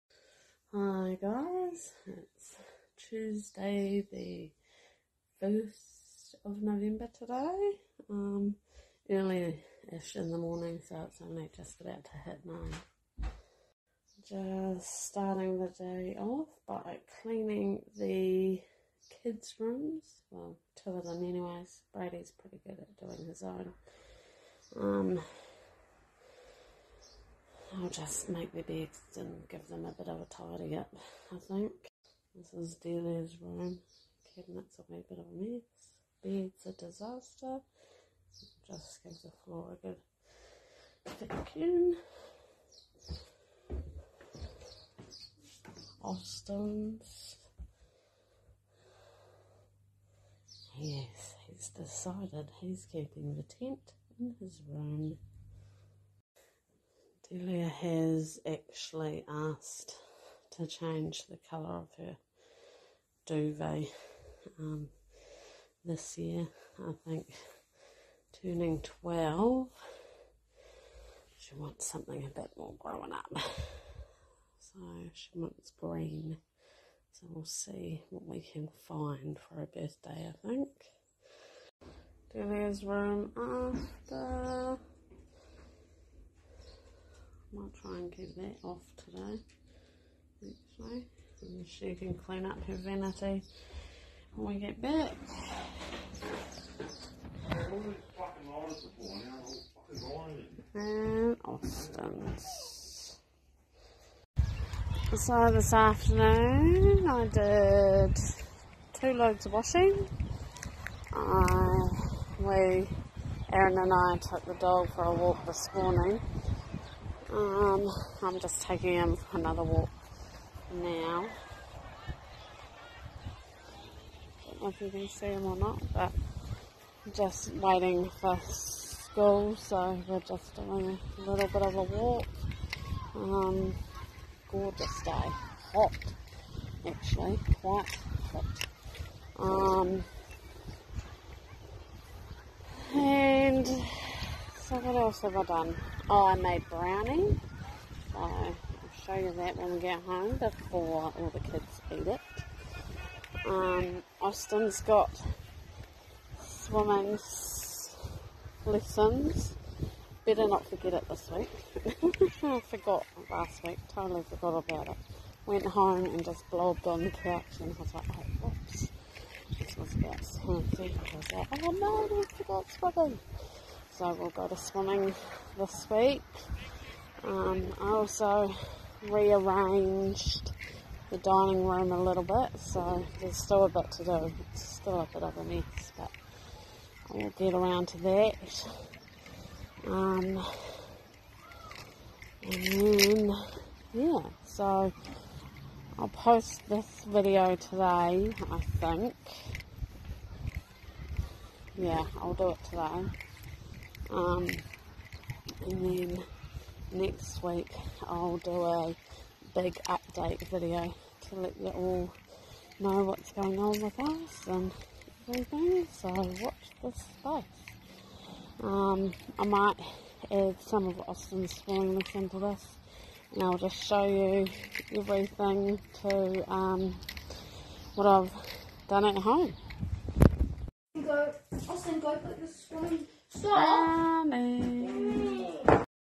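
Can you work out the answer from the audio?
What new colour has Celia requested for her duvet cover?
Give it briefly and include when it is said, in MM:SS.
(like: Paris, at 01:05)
Green, at 01:15.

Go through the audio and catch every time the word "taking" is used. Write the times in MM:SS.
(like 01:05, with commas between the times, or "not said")
01:58.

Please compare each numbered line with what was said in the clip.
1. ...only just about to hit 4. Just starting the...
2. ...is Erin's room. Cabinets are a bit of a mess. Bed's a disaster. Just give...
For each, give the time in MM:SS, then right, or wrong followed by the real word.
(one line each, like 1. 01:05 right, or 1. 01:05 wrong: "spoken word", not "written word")
1. 00:11 wrong: "9", not "4"
2. 00:32 wrong: "Delia", not "Erin".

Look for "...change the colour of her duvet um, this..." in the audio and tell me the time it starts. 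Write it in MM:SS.
01:00.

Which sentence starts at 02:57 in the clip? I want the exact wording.
Um, I also rearranged the dining room a little bit, so there's still a bit to do.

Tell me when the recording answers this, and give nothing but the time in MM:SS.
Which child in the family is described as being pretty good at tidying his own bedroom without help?
00:21.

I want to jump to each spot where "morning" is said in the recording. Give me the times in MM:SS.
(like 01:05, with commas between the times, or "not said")
00:10, 01:55.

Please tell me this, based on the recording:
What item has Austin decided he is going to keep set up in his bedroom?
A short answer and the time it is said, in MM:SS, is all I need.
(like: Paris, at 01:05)
Tent, at 00:53.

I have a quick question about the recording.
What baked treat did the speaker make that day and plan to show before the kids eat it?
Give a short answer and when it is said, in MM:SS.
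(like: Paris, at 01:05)
Brownie, at 02:26.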